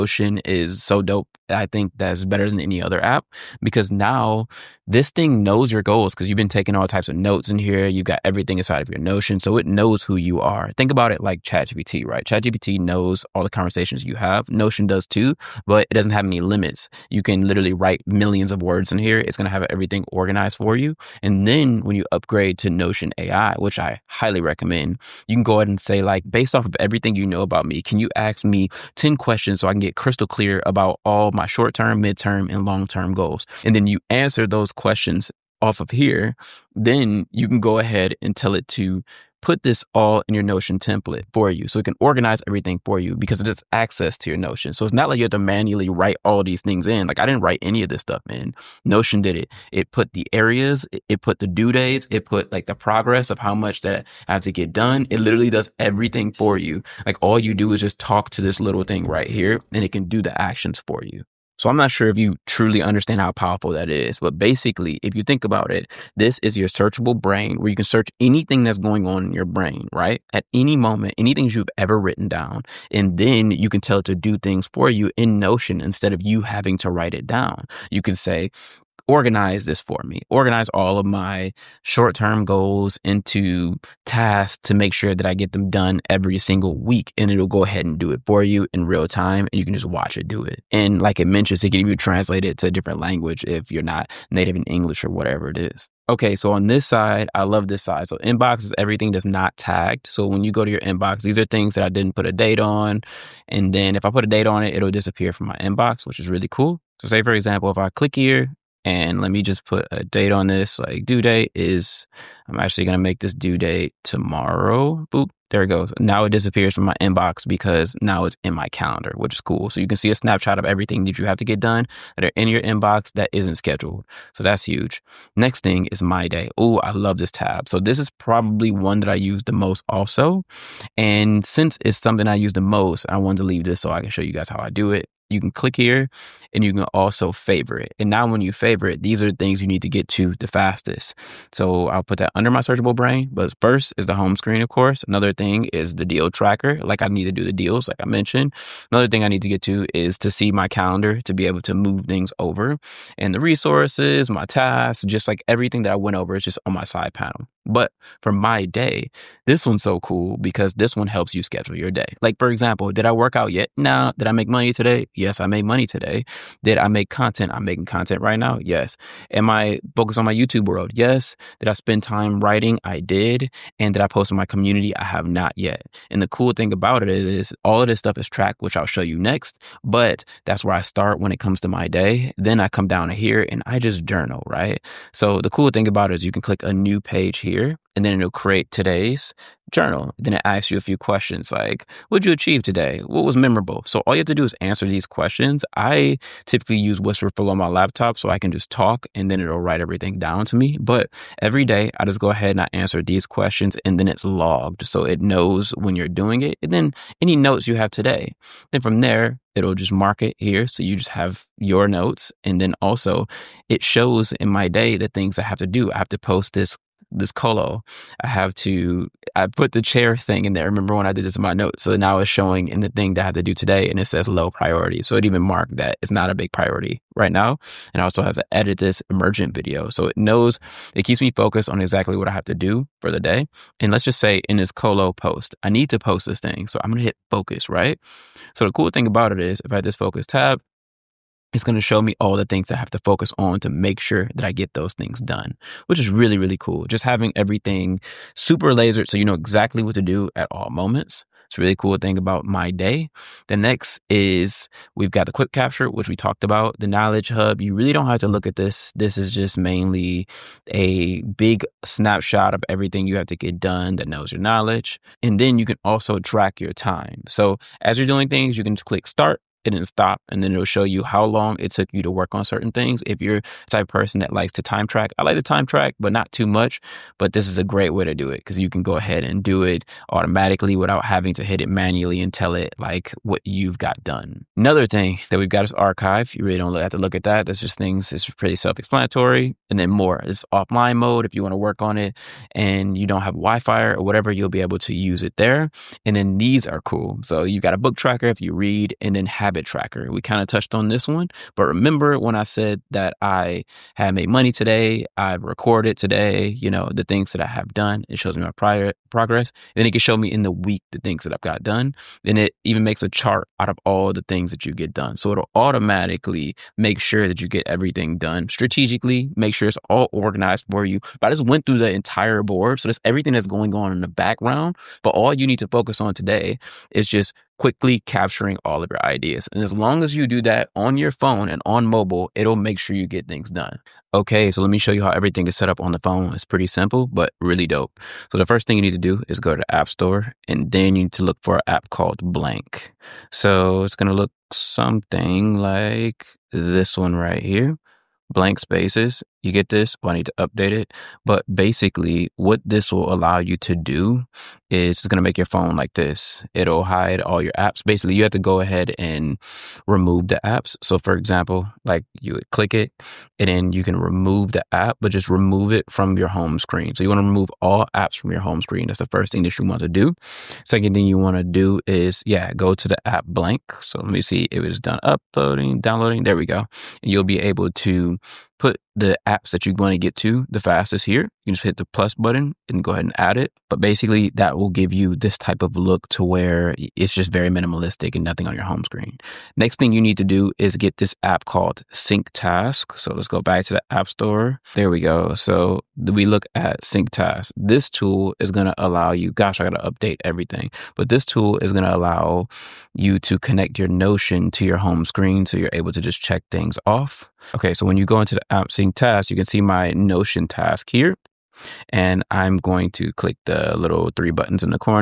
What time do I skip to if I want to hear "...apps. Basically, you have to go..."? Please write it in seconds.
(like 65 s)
357 s.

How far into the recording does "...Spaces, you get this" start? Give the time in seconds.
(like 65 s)
348 s.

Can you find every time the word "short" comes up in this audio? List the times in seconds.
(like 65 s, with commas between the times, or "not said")
31 s, 81 s.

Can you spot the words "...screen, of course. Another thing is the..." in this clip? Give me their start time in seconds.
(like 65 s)
144 s.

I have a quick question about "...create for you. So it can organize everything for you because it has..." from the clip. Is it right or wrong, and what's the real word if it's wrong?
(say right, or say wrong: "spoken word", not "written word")
wrong: "template", not "create".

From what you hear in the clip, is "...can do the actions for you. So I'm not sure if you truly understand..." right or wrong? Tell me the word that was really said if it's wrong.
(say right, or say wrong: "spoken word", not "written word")
right.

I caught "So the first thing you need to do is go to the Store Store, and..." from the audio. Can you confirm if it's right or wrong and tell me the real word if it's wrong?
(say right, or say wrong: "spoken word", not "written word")
wrong: "App", not "Store".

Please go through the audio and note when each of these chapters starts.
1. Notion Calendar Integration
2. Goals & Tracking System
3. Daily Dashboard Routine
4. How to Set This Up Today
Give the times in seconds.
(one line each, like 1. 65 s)
1. 102 s
2. 177 s
3. 267 s
4. 357 s.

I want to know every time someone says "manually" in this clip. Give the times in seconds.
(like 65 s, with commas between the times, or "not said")
45 s, 281 s.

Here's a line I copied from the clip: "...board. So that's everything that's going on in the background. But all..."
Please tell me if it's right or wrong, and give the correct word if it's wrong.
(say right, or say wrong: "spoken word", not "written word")
right.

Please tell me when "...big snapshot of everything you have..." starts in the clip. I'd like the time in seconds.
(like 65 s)
261 s.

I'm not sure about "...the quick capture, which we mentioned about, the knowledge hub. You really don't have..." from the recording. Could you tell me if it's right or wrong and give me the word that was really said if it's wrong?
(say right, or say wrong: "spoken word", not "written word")
wrong: "talked", not "mentioned".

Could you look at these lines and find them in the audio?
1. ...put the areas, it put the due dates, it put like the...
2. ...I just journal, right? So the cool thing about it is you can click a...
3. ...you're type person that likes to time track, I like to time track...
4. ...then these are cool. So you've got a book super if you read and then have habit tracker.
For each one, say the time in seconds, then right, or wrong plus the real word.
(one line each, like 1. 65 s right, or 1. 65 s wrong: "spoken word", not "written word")
1. 49 s right
2. 183 s right
3. 273 s right
4. 296 s wrong: "tracker", not "super".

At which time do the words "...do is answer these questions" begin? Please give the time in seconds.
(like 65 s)
194 s.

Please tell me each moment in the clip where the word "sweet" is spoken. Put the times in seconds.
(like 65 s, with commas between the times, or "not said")
not said.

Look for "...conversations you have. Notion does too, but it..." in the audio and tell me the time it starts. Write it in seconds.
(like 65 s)
13 s.